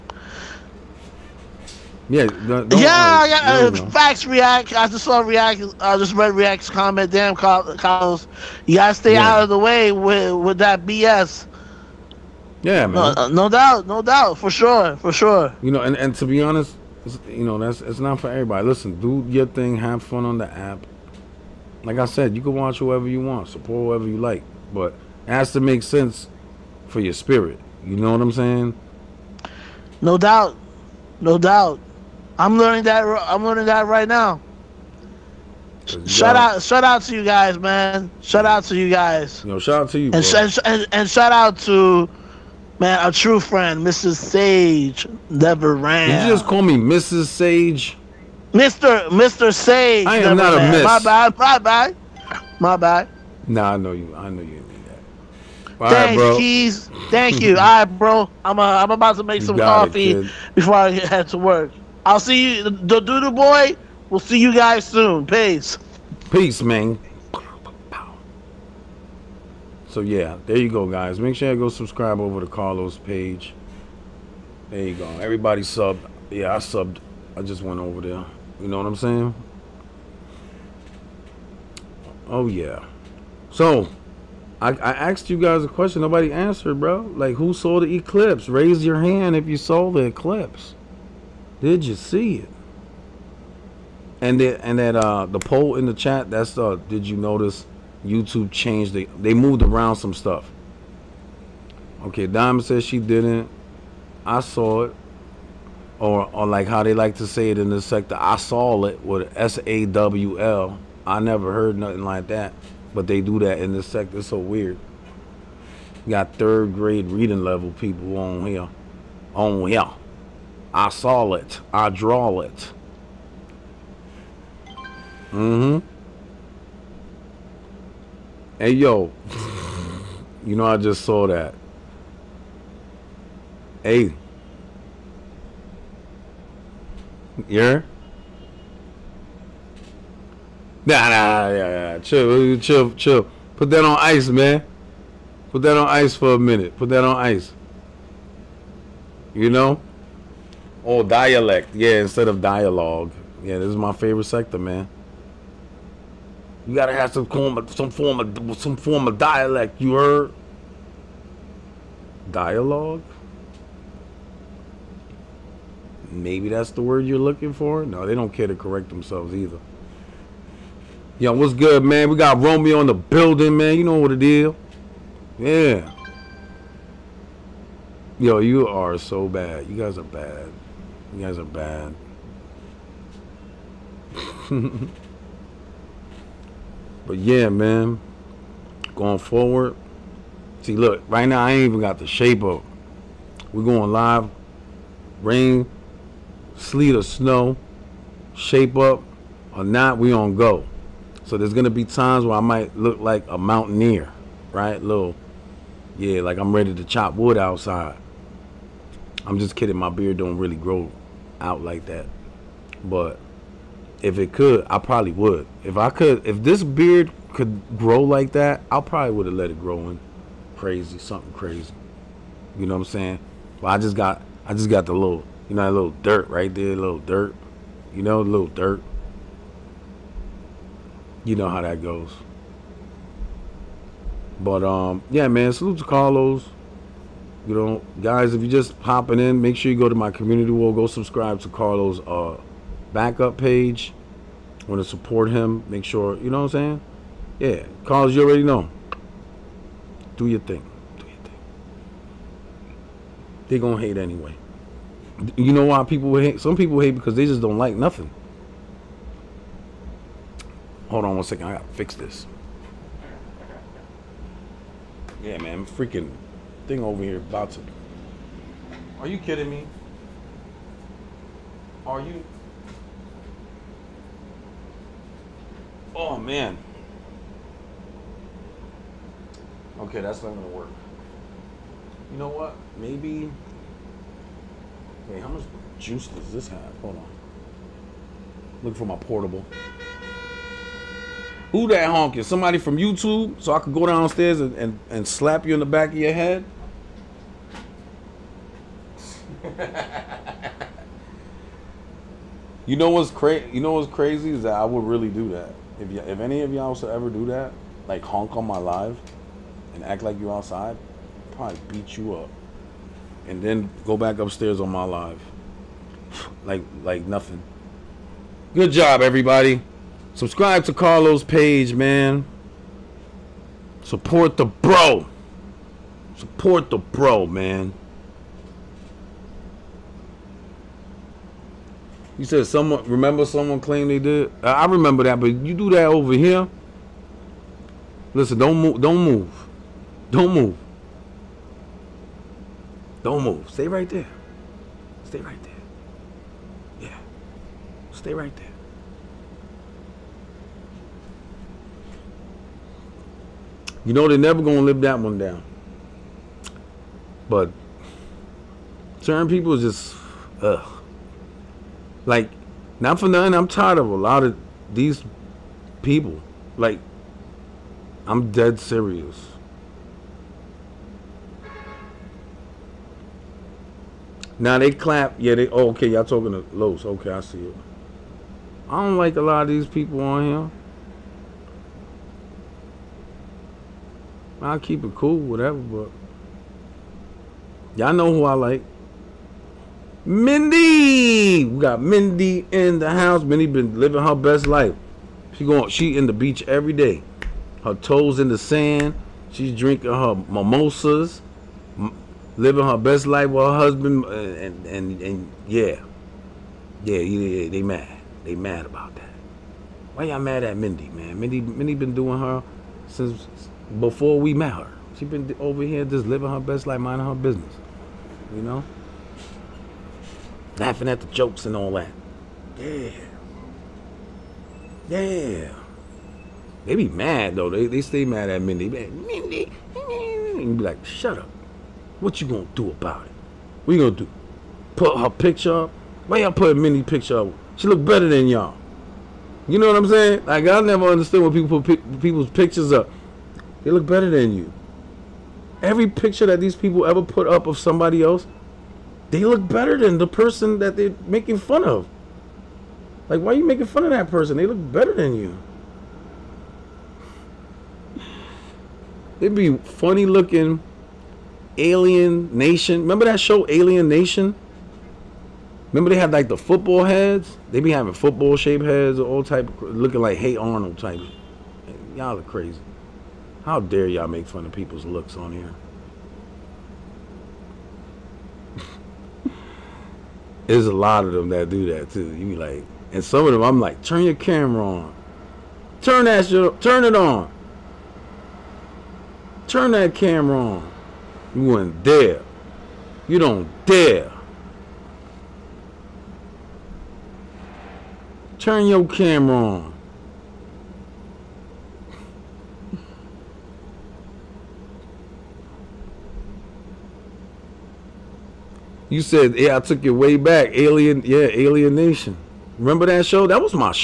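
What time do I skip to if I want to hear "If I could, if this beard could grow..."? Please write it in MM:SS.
03:35.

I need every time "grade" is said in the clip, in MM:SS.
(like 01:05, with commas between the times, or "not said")
01:56.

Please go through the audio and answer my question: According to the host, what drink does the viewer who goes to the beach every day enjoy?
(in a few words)
Mimosas.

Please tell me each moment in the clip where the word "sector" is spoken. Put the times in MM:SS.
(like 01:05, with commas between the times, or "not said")
01:47, 01:53, 02:34.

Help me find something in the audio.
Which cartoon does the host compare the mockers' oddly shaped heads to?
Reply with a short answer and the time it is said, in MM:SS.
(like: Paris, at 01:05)
Hey Arnold, at 07:50.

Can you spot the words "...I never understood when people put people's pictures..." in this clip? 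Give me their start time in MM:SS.
07:20.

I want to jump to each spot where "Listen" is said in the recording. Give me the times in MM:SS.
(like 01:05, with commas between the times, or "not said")
00:18, 05:38.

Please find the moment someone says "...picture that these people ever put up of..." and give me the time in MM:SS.
07:25.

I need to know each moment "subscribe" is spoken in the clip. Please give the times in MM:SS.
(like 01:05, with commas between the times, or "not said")
01:11, 04:00, 05:20.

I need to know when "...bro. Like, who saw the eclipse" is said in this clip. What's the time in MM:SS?
01:26.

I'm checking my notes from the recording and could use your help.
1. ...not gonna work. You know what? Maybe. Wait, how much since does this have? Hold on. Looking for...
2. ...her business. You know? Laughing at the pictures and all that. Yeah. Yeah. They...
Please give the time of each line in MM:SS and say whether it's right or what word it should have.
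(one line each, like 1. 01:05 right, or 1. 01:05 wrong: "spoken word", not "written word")
1. 04:40 wrong: "juice", not "since"
2. 06:57 wrong: "jokes", not "pictures".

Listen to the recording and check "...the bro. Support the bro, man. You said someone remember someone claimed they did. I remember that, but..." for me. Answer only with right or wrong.
right.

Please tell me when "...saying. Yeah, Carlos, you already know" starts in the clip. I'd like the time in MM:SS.
04:06.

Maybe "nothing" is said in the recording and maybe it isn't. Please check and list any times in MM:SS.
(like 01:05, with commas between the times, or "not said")
01:51, 04:17, 05:17, 06:03.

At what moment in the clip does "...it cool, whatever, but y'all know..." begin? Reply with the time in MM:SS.
06:24.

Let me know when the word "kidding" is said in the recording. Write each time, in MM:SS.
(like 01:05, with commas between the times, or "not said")
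03:29, 04:29.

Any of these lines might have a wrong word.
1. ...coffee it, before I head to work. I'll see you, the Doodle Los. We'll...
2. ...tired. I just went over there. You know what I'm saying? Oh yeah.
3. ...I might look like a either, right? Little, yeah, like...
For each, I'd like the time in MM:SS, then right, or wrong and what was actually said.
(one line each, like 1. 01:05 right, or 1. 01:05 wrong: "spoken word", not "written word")
1. 00:59 wrong: "Boy", not "Los"
2. 01:16 wrong: "subbed", not "tired"
3. 03:22 wrong: "mountaineer", not "either".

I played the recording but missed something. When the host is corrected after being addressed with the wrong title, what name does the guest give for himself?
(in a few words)
Mr. Sage.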